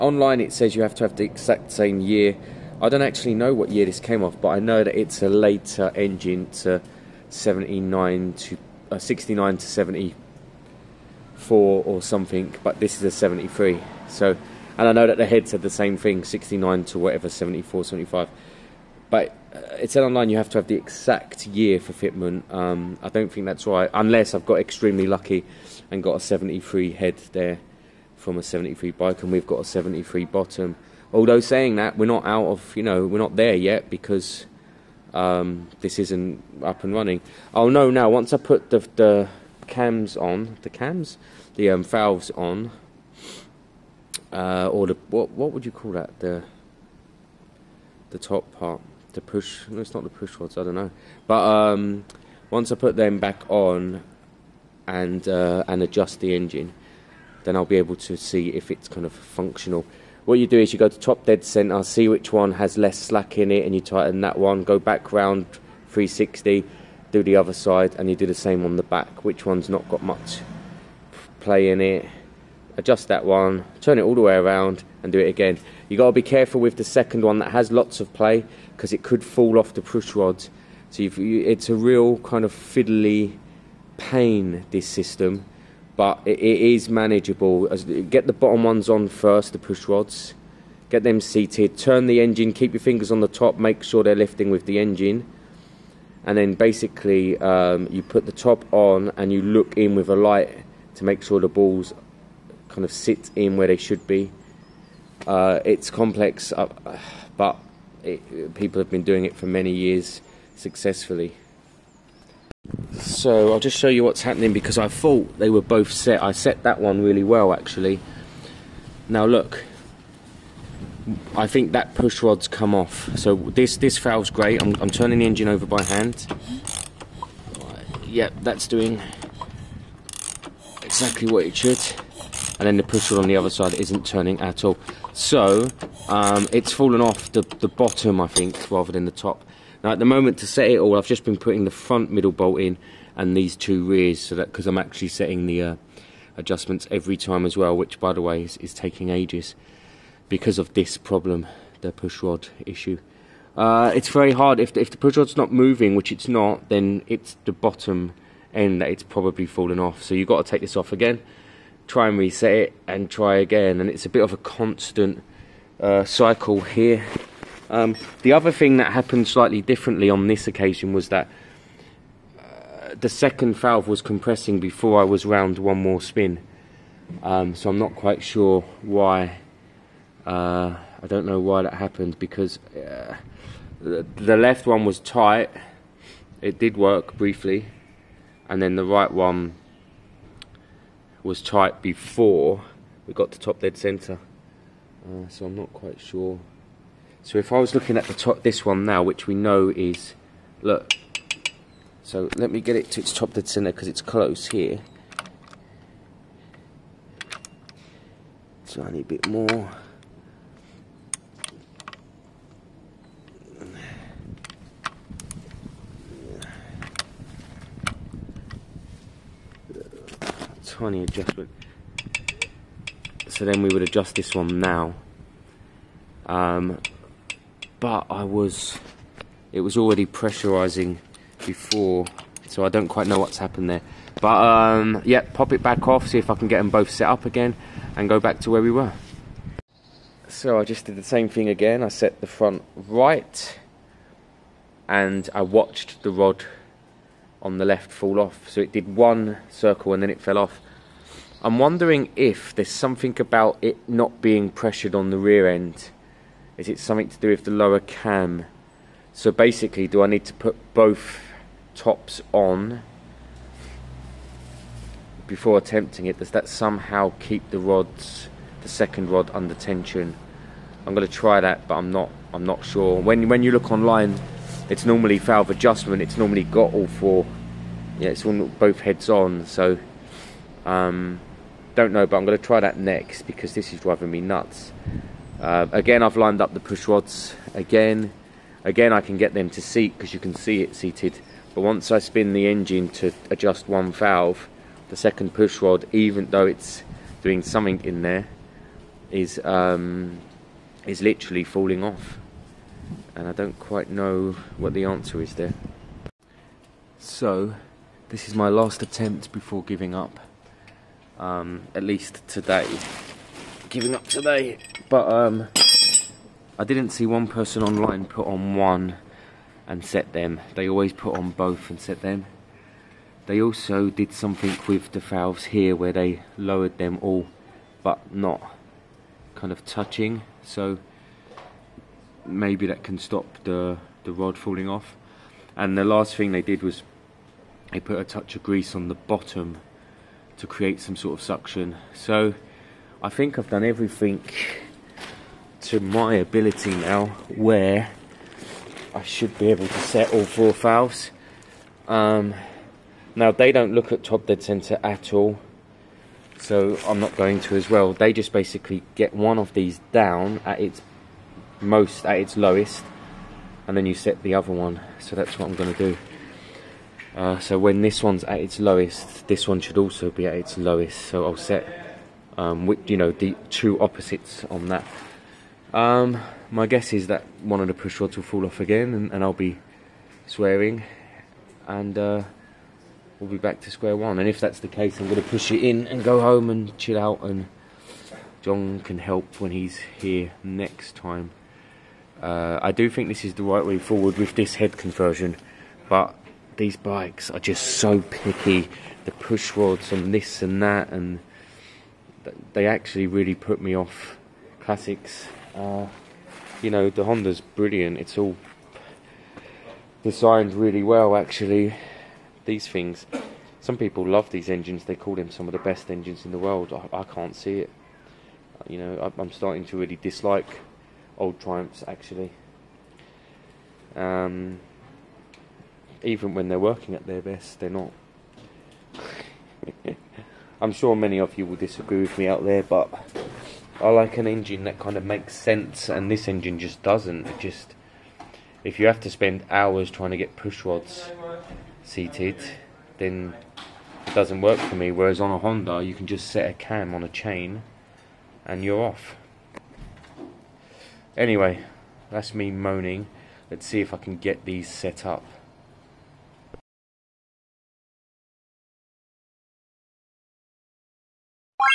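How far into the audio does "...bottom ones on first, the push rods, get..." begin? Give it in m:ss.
1:28.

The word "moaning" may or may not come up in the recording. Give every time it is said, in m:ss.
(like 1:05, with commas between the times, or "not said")
7:32.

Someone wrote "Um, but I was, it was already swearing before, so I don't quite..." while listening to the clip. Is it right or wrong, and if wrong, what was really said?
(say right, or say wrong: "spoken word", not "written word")
wrong: "pressurizing", not "swearing".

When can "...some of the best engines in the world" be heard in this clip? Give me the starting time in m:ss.
6:55.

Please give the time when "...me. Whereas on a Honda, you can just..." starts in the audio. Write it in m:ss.
7:24.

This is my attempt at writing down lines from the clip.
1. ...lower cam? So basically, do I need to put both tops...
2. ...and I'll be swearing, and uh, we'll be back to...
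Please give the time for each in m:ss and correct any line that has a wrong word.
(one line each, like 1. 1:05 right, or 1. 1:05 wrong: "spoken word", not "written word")
1. 4:17 right
2. 6:19 right.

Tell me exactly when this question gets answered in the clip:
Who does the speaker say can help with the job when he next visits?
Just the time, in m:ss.
6:28.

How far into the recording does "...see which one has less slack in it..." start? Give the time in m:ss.
1:01.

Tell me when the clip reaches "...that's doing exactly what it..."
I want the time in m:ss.
2:08.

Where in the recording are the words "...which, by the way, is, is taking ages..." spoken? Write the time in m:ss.
2:27.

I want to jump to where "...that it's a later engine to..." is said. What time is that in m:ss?
0:04.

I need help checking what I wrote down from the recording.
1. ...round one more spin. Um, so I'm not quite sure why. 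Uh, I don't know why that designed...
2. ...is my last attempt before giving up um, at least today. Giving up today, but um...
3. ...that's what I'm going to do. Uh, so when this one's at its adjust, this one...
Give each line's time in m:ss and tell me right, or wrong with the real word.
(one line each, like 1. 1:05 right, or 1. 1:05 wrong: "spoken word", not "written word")
1. 2:55 wrong: "happened", not "designed"
2. 5:08 right
3. 6:05 wrong: "lowest", not "adjust".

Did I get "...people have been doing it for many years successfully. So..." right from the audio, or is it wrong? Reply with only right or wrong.
right.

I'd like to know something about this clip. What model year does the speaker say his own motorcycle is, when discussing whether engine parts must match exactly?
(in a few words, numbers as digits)
1973.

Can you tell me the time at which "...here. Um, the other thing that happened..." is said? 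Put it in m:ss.
2:46.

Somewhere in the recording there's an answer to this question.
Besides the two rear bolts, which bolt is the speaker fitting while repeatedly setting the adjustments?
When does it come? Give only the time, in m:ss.
2:21.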